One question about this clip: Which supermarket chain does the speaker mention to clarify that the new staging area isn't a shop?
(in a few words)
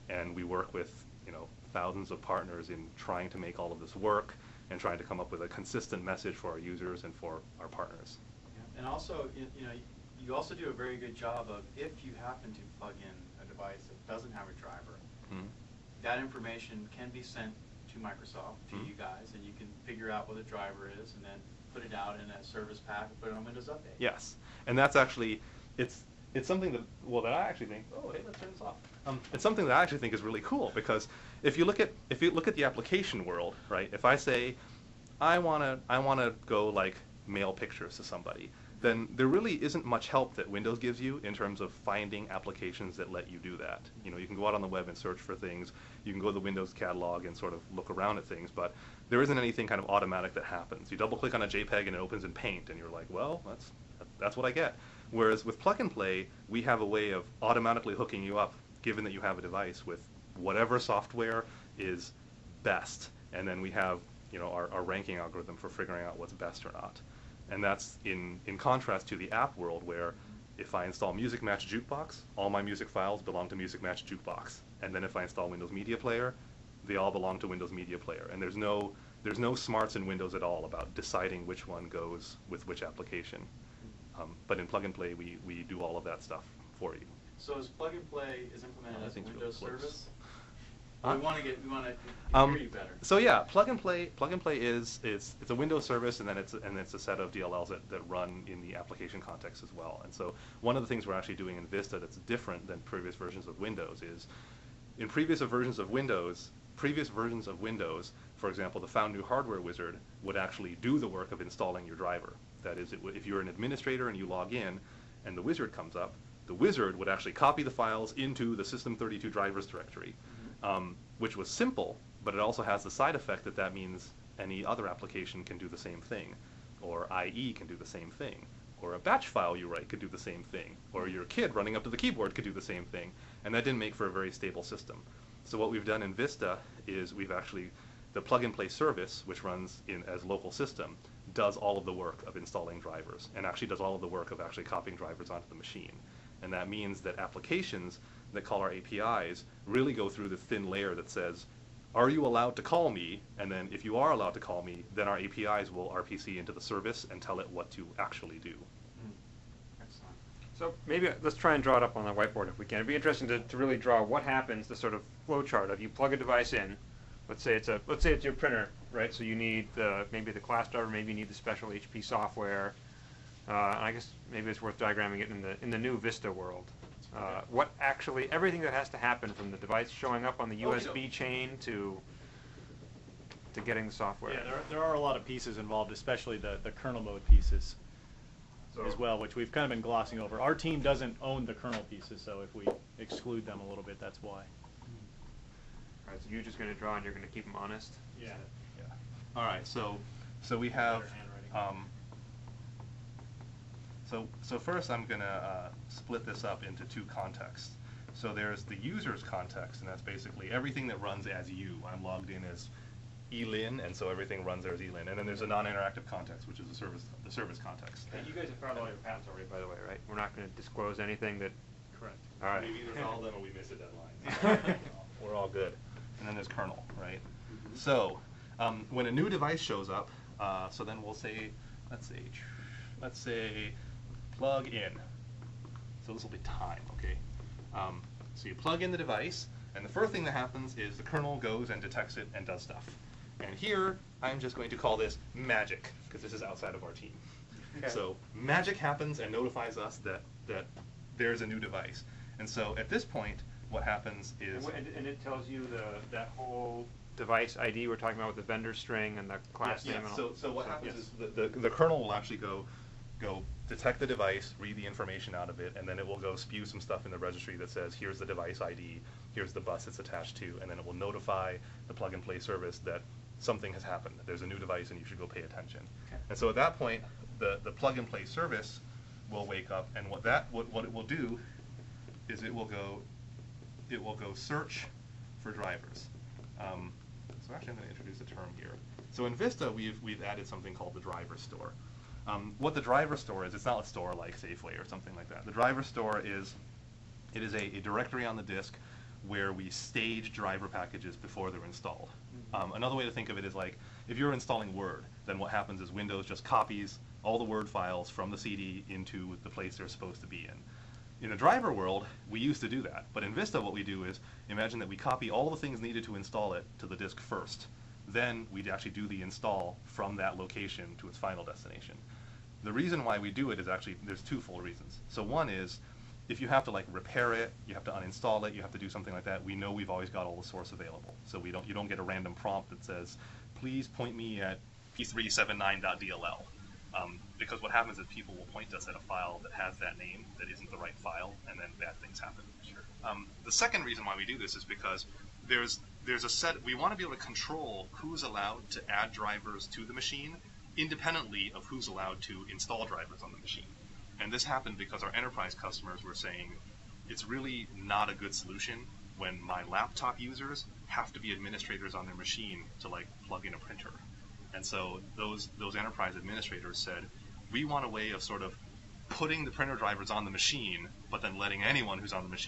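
Safeway.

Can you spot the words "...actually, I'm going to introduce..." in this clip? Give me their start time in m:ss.
4:47.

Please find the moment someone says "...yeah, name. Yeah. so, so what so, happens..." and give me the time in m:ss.
4:19.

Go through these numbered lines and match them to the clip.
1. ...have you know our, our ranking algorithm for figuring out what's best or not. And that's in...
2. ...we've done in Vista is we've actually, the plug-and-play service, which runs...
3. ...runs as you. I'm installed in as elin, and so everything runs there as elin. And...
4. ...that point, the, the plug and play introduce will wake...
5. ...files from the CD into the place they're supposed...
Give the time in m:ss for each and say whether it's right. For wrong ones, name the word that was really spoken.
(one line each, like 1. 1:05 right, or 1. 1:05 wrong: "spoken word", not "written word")
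1. 1:03 right
2. 2:15 right
3. 3:30 wrong: "logged", not "installed"
4. 4:36 wrong: "service", not "introduce"
5. 5:07 right.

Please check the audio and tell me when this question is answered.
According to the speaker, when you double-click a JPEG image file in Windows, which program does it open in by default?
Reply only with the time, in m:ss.
0:52.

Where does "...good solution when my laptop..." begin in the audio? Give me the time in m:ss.
5:58.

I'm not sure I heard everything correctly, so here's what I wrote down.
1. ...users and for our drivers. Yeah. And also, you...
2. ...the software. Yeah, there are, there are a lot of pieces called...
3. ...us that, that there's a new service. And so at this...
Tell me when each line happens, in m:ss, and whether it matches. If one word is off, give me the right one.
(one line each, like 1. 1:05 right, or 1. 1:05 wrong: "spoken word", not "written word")
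1. 0:06 wrong: "partners", not "drivers"
2. 3:03 wrong: "involved", not "called"
3. 4:09 wrong: "device", not "service".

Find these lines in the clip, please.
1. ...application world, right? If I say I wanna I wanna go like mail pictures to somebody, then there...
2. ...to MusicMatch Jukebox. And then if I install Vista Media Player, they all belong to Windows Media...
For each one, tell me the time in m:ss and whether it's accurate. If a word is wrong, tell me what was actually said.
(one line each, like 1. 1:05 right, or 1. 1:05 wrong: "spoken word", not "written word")
1. 0:32 right
2. 1:13 wrong: "Windows", not "Vista".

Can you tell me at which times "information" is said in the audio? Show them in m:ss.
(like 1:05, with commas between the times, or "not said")
0:16, 4:24.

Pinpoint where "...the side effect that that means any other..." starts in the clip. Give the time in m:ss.
2:02.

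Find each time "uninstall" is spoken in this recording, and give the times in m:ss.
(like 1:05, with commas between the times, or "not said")
5:27.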